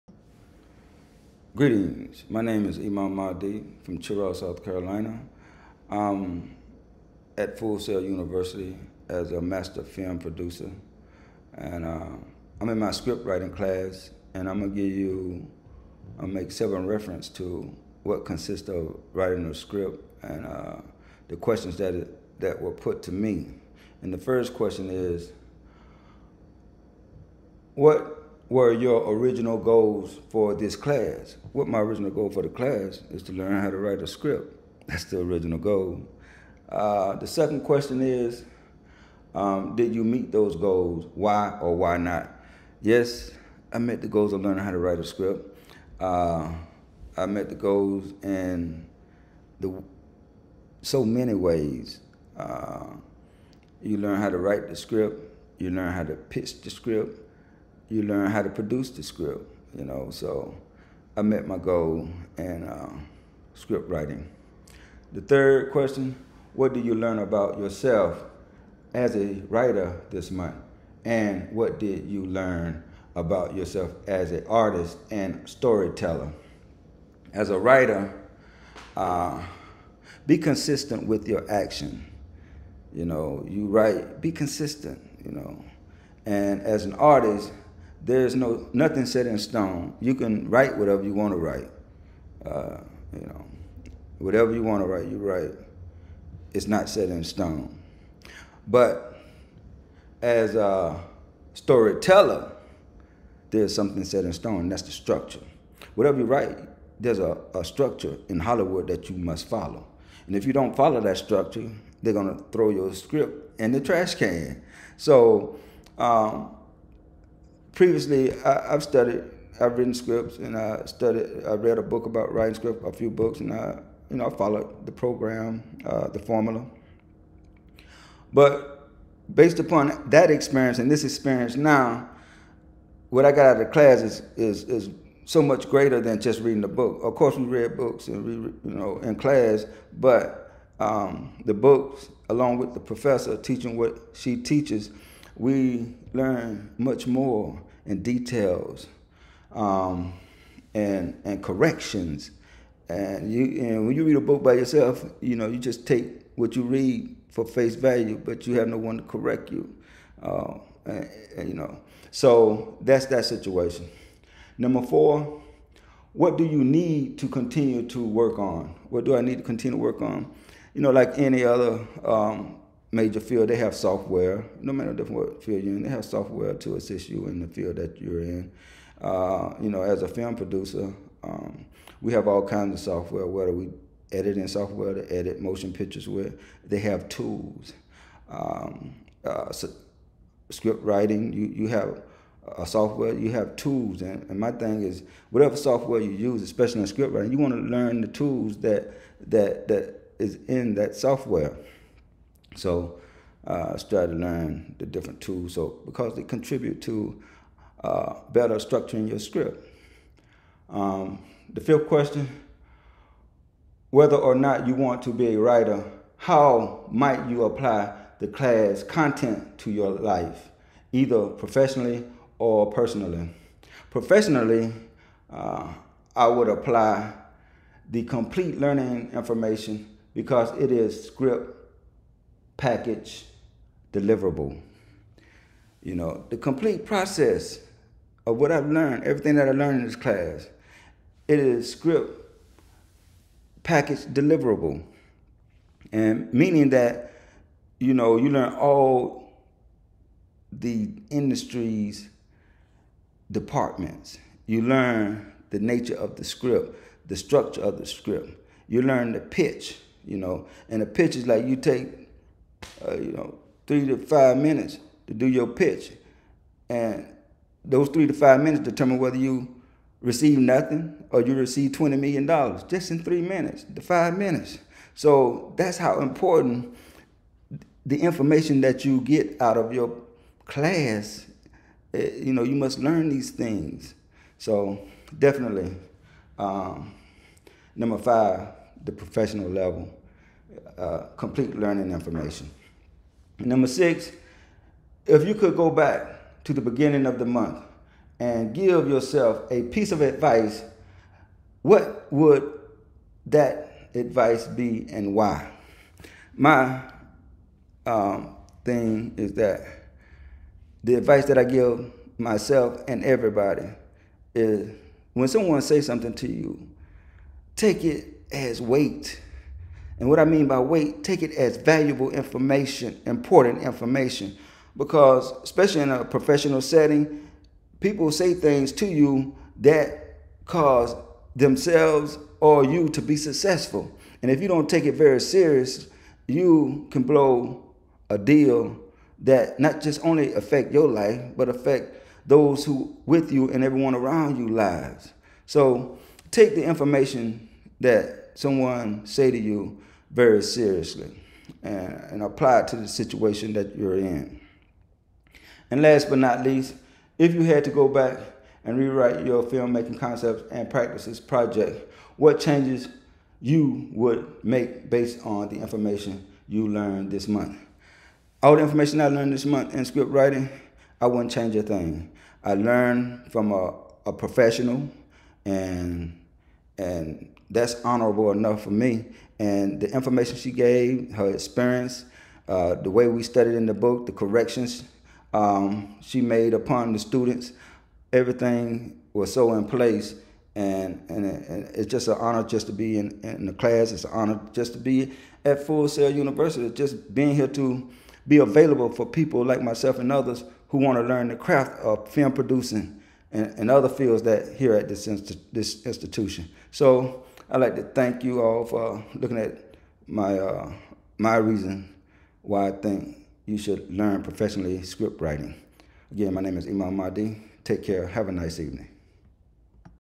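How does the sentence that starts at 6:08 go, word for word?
All the information I learned this month in script writing, I wouldn't change a thing.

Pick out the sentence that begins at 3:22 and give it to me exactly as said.
So uh, I started to learn the different tools.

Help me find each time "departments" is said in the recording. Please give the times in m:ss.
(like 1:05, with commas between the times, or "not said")
4:13.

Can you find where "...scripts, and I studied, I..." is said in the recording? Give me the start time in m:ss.
1:59.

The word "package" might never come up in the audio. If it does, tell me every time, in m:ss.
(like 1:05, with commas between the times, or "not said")
3:52, 4:03.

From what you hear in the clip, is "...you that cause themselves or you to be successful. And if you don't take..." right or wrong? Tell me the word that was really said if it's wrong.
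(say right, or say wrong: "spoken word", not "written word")
right.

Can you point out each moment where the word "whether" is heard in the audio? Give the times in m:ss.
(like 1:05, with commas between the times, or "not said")
3:03, 3:33, 4:28.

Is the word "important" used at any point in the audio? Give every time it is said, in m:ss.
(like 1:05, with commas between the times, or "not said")
4:35, 5:23.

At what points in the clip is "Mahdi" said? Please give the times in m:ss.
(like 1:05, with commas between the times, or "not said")
0:03, 6:56.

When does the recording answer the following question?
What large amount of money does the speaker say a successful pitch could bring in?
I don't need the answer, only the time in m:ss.
4:31.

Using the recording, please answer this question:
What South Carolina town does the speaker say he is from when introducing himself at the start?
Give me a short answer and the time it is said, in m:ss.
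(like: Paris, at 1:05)
Cheraw, at 0:03.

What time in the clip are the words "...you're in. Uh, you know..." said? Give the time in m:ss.
2:58.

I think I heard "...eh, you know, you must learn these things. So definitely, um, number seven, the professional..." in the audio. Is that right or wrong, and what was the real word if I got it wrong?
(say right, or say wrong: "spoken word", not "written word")
wrong: "five", not "seven".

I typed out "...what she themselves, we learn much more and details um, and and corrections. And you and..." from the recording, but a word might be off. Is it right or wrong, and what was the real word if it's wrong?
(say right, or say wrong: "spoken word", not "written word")
wrong: "teaches", not "themselves".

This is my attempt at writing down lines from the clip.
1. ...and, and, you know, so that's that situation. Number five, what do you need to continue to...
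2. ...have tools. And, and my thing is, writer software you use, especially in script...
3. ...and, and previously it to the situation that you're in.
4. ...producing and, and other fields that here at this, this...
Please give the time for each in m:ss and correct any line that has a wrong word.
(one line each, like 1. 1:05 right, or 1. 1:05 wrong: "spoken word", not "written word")
1. 2:40 wrong: "four", not "five"
2. 3:13 wrong: "whatever", not "writer"
3. 5:51 wrong: "apply", not "previously"
4. 6:42 right.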